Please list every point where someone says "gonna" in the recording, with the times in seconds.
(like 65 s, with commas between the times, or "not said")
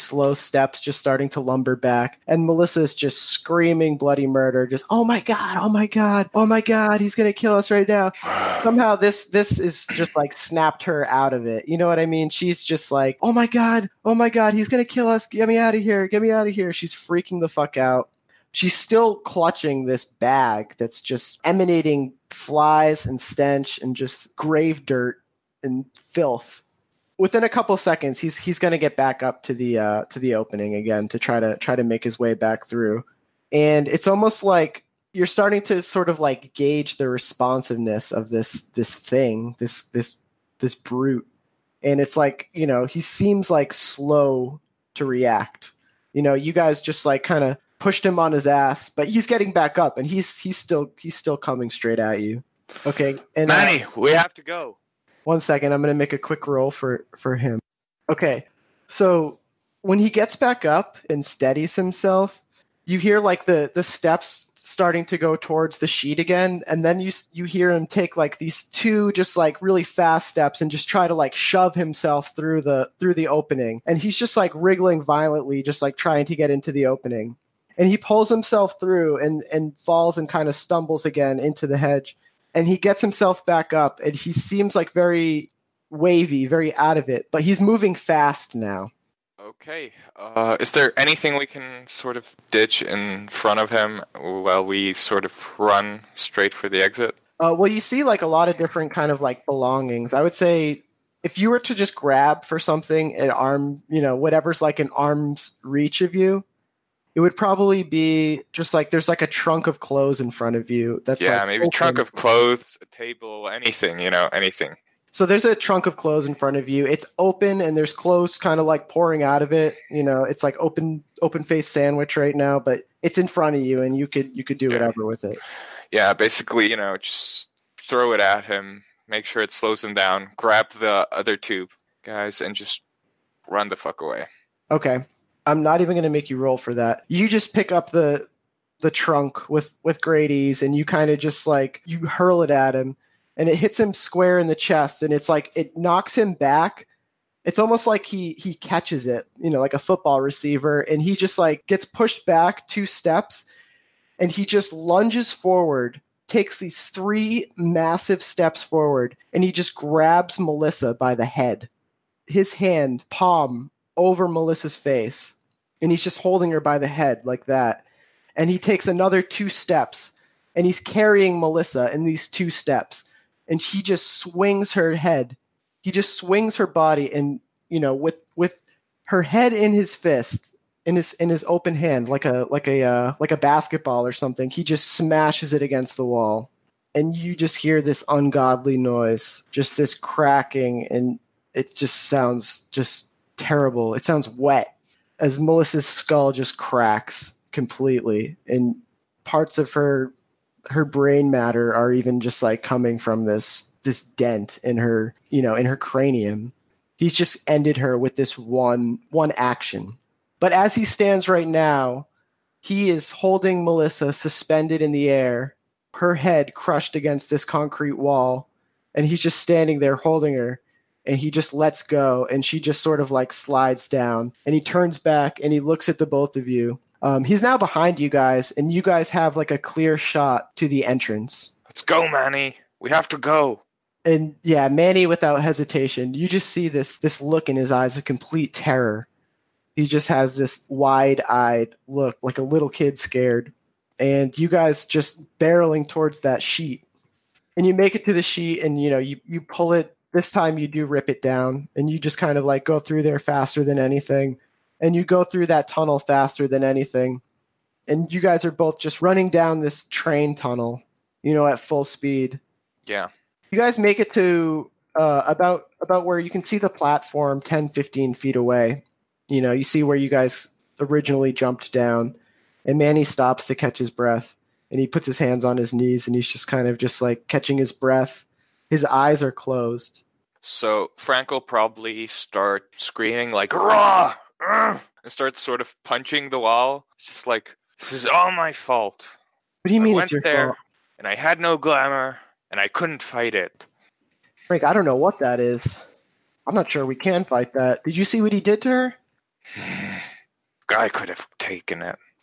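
7 s, 14 s.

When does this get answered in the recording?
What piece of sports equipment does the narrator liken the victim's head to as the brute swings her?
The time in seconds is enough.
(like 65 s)
183 s.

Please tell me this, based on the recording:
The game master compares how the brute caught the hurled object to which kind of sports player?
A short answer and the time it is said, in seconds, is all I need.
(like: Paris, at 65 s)
football receiver, at 149 s.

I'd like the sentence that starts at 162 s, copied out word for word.
His hand, palm over Melissa's face and he's just holding her by the head like that.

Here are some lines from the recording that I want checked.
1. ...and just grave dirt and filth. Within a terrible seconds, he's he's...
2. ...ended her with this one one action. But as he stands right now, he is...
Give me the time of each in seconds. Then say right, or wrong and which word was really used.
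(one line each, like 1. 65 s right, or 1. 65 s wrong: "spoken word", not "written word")
1. 23 s wrong: "couple", not "terrible"
2. 207 s right.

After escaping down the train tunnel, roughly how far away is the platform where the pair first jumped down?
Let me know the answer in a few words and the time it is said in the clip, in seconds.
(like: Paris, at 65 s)
10 to 15 feet, at 267 s.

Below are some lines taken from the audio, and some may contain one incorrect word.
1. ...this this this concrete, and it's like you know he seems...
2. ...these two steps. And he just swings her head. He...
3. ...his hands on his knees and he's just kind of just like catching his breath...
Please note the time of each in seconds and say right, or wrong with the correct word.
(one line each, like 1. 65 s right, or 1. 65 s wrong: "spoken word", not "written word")
1. 39 s wrong: "brute", not "concrete"
2. 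172 s right
3. 275 s right.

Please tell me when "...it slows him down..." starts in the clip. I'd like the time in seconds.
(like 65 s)
129 s.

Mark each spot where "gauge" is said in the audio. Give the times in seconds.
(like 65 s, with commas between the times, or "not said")
36 s.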